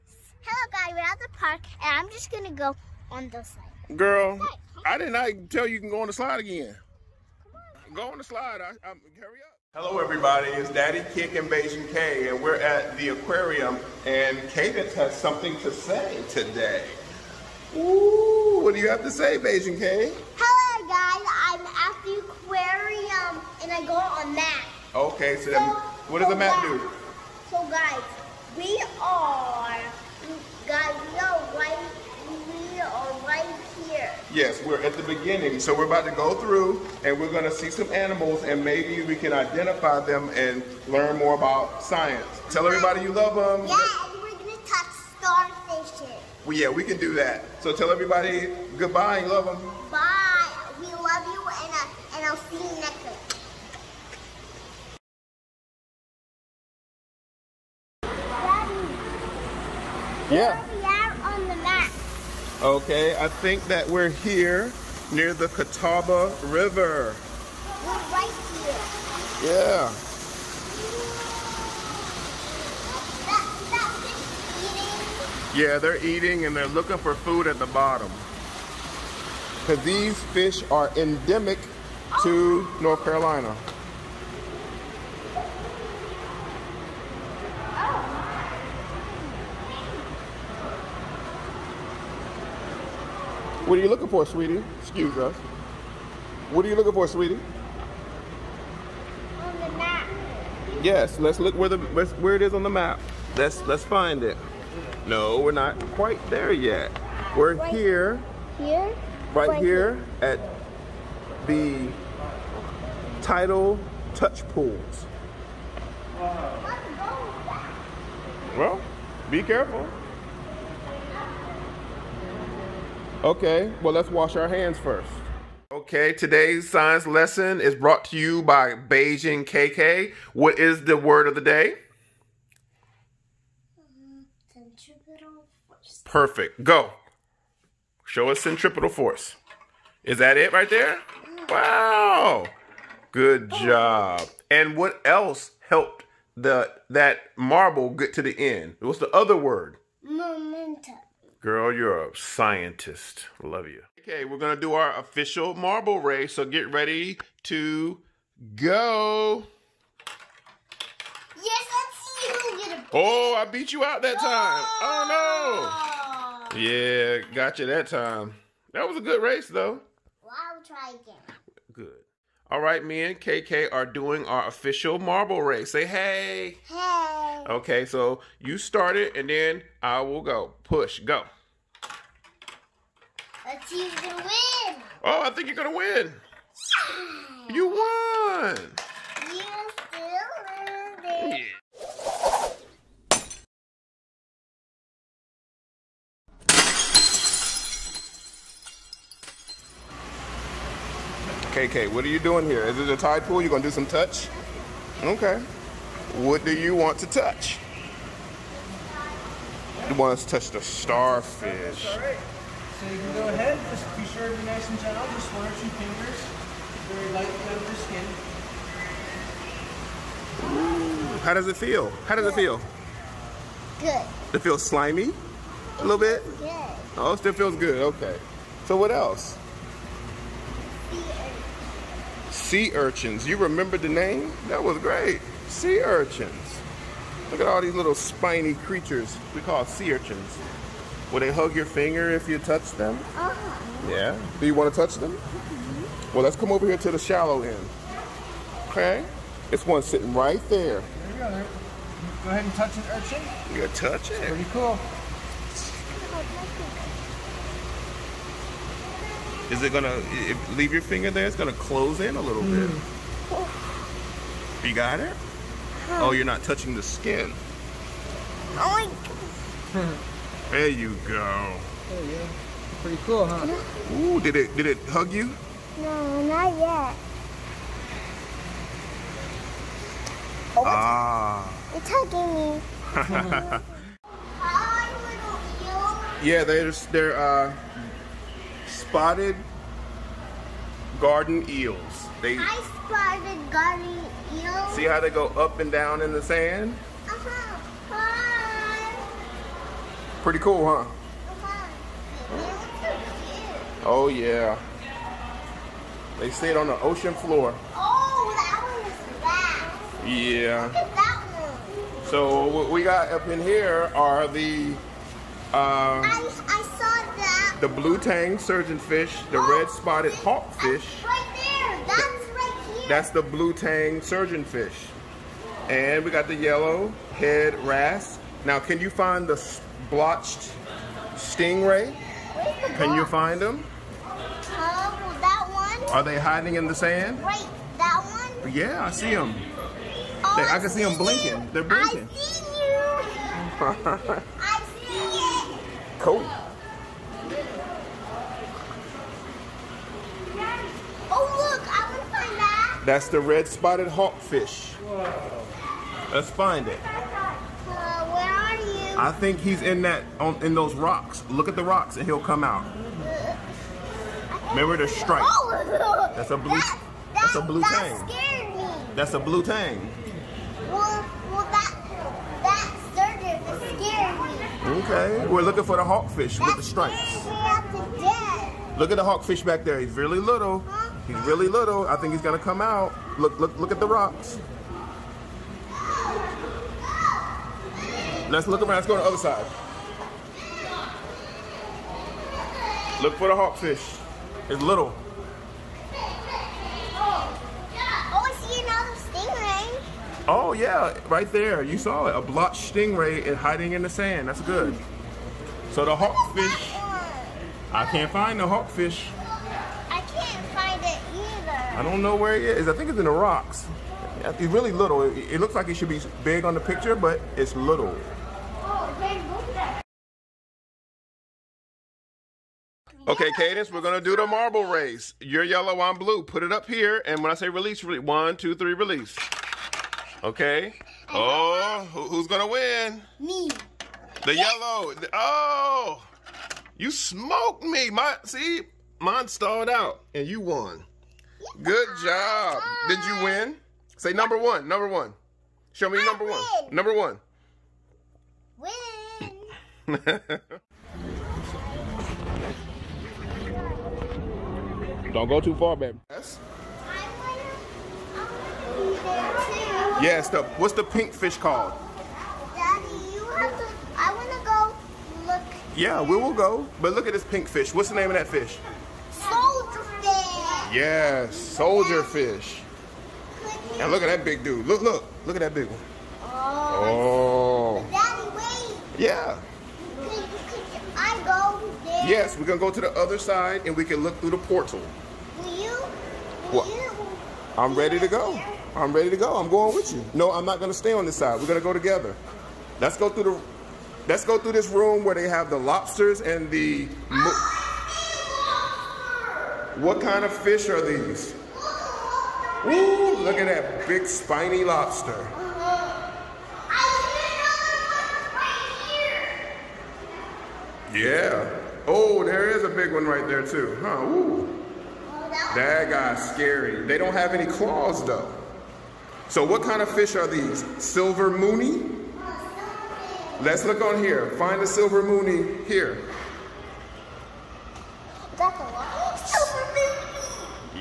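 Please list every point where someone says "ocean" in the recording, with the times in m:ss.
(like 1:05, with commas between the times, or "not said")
5:06.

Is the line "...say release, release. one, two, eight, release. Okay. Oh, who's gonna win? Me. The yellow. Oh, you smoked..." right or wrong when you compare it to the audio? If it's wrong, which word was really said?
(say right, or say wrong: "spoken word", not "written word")
wrong: "three", not "eight".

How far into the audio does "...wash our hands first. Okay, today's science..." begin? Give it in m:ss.
2:04.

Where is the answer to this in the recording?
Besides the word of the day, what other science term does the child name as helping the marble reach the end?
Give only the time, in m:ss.
2:30.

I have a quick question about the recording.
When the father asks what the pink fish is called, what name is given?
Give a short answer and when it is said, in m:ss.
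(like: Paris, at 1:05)
Soldier fish, at 7:51.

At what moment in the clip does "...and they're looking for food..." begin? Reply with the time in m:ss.
1:16.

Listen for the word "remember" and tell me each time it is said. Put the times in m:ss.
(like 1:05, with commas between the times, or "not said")
3:53, 6:04.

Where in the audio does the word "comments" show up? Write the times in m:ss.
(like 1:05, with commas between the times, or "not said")
not said.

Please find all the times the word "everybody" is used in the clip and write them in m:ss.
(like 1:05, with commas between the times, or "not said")
0:09, 0:42, 0:47.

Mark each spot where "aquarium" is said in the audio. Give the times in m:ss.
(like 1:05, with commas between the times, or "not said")
0:13, 0:22.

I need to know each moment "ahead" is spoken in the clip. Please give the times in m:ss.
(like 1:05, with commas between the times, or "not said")
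3:33, 4:12.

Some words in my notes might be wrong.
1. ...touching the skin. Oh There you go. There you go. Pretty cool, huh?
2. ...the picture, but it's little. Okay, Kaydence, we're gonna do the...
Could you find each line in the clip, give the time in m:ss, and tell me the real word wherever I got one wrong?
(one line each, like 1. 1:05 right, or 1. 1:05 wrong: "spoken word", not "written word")
1. 4:26 right
2. 6:56 right.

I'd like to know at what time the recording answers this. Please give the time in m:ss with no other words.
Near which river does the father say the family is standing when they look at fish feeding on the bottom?
1:05.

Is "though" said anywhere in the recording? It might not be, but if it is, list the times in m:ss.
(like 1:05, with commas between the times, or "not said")
2:49, 8:38.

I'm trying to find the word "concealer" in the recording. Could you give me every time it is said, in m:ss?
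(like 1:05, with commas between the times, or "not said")
not said.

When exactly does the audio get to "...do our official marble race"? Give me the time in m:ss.
2:34.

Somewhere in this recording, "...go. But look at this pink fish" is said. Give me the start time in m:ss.
7:46.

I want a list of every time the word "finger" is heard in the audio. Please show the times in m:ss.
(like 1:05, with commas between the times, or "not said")
3:35, 4:01, 4:20.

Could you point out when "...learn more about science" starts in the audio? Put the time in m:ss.
0:40.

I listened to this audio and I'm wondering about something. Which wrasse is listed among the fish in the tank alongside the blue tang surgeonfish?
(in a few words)
Yellow head wrasse.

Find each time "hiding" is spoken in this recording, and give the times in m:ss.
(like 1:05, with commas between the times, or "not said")
5:36, 6:43.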